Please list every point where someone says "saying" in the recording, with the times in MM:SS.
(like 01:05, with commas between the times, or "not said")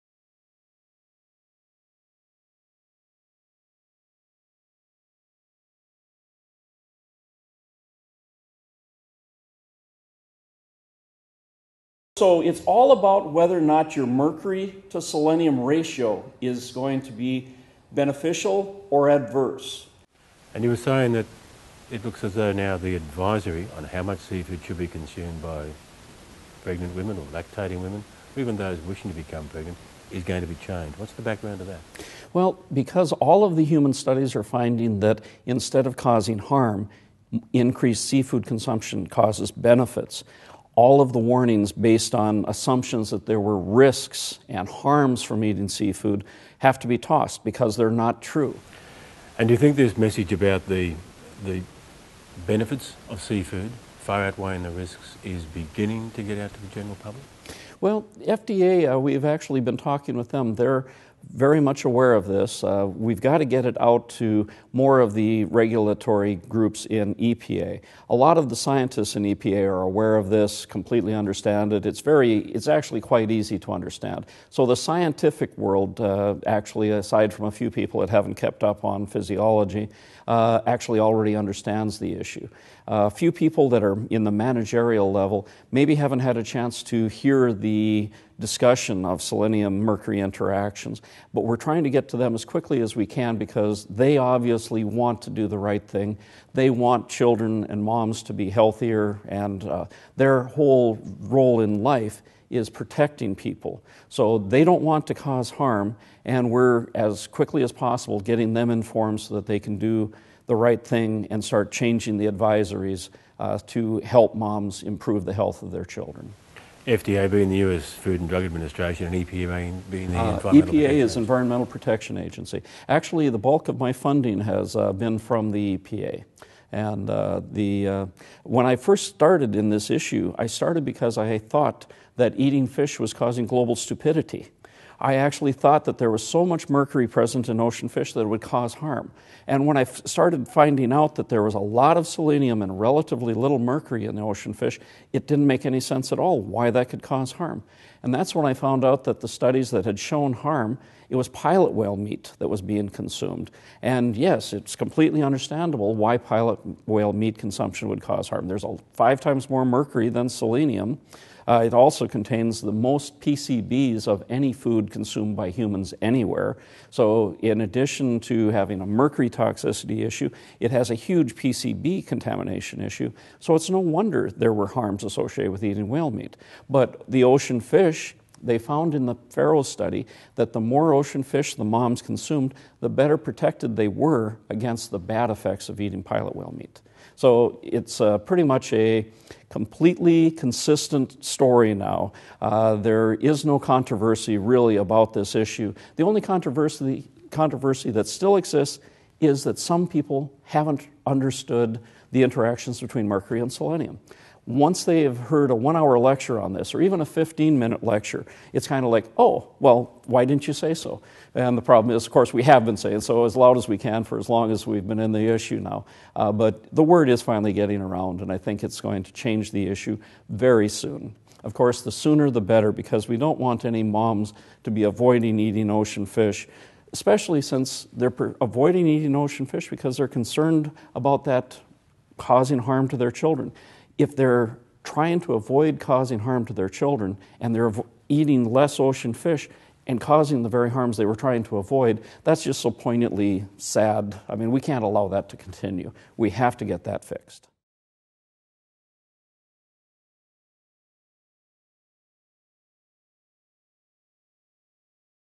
00:20, 03:32.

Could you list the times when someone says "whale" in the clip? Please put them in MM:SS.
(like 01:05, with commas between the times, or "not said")
02:31, 02:36, 02:55, 03:06.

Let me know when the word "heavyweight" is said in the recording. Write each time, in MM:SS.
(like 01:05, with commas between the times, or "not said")
not said.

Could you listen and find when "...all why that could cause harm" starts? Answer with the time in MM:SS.
02:26.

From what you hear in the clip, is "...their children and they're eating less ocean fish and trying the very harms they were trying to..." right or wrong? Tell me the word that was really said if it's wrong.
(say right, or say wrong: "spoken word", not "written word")
wrong: "causing", not "trying".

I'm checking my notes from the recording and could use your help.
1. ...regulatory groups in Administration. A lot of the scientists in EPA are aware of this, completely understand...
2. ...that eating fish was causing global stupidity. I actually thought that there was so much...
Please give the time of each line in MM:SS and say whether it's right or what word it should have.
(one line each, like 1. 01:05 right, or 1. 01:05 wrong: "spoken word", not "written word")
1. 01:05 wrong: "EPA", not "Administration"
2. 02:12 right.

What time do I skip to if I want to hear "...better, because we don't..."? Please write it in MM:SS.
03:42.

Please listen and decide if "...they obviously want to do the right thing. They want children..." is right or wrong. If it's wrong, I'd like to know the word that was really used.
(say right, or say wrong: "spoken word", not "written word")
right.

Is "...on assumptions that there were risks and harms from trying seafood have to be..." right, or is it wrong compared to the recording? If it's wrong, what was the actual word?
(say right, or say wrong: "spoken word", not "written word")
wrong: "eating", not "trying".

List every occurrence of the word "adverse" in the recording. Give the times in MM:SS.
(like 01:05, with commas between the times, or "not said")
00:19.